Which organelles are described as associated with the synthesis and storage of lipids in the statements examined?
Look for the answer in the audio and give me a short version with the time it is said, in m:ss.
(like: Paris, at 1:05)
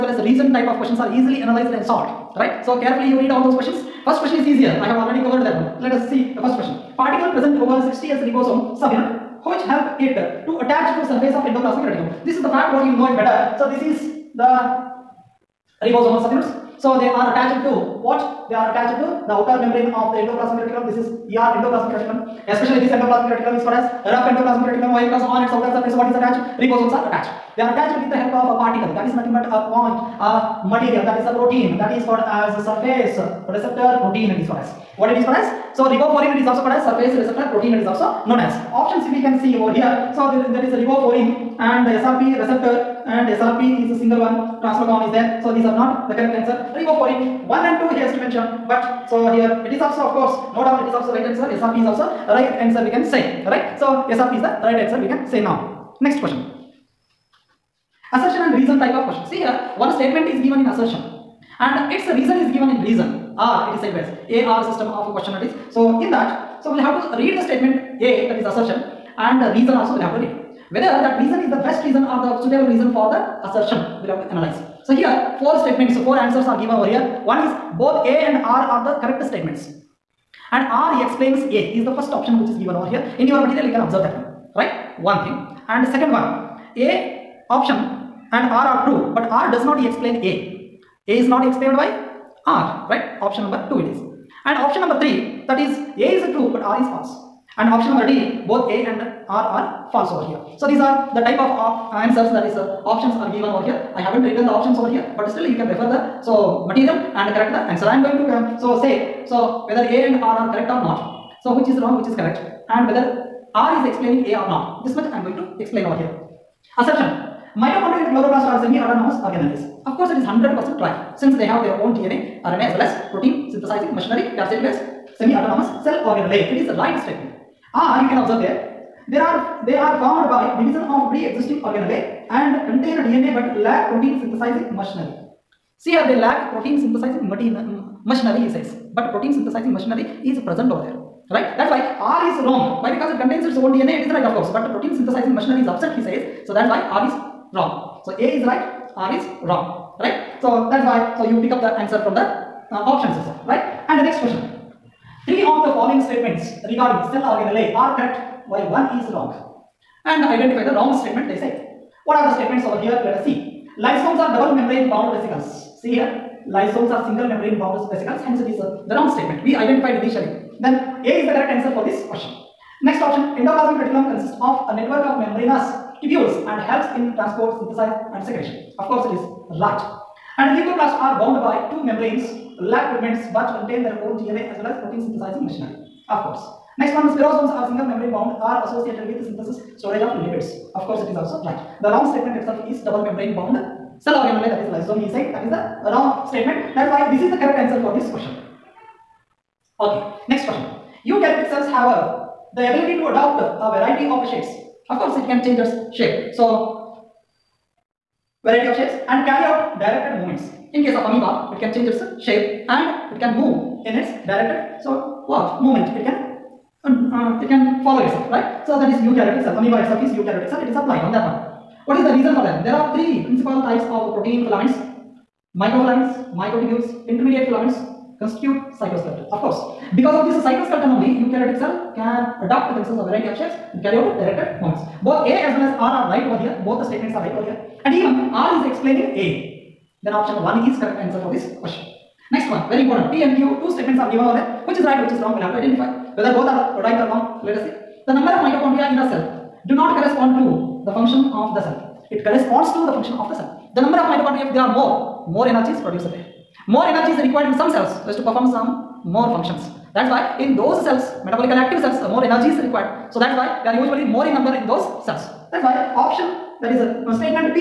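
Spherosomes, at 3:07.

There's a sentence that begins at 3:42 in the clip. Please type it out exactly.
There are three principal types of protein filaments.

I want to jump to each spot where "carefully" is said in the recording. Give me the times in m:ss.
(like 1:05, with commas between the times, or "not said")
0:02.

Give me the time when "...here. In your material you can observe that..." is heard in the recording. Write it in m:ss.
1:22.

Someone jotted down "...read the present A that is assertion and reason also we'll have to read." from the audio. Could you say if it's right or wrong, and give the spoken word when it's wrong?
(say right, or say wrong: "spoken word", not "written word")
wrong: "statement", not "present".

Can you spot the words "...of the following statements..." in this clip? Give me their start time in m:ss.
2:35.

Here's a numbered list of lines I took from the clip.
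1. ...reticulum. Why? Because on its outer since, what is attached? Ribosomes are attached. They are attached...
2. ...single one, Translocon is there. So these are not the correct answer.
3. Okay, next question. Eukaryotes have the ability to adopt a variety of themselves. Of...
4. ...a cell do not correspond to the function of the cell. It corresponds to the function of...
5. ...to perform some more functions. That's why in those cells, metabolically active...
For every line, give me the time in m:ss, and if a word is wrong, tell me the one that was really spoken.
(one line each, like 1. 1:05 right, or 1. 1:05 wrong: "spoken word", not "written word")
1. 0:24 wrong: "surface", not "since"
2. 0:43 right
3. 3:19 wrong: "shapes", not "themselves"
4. 4:08 right
5. 4:18 right.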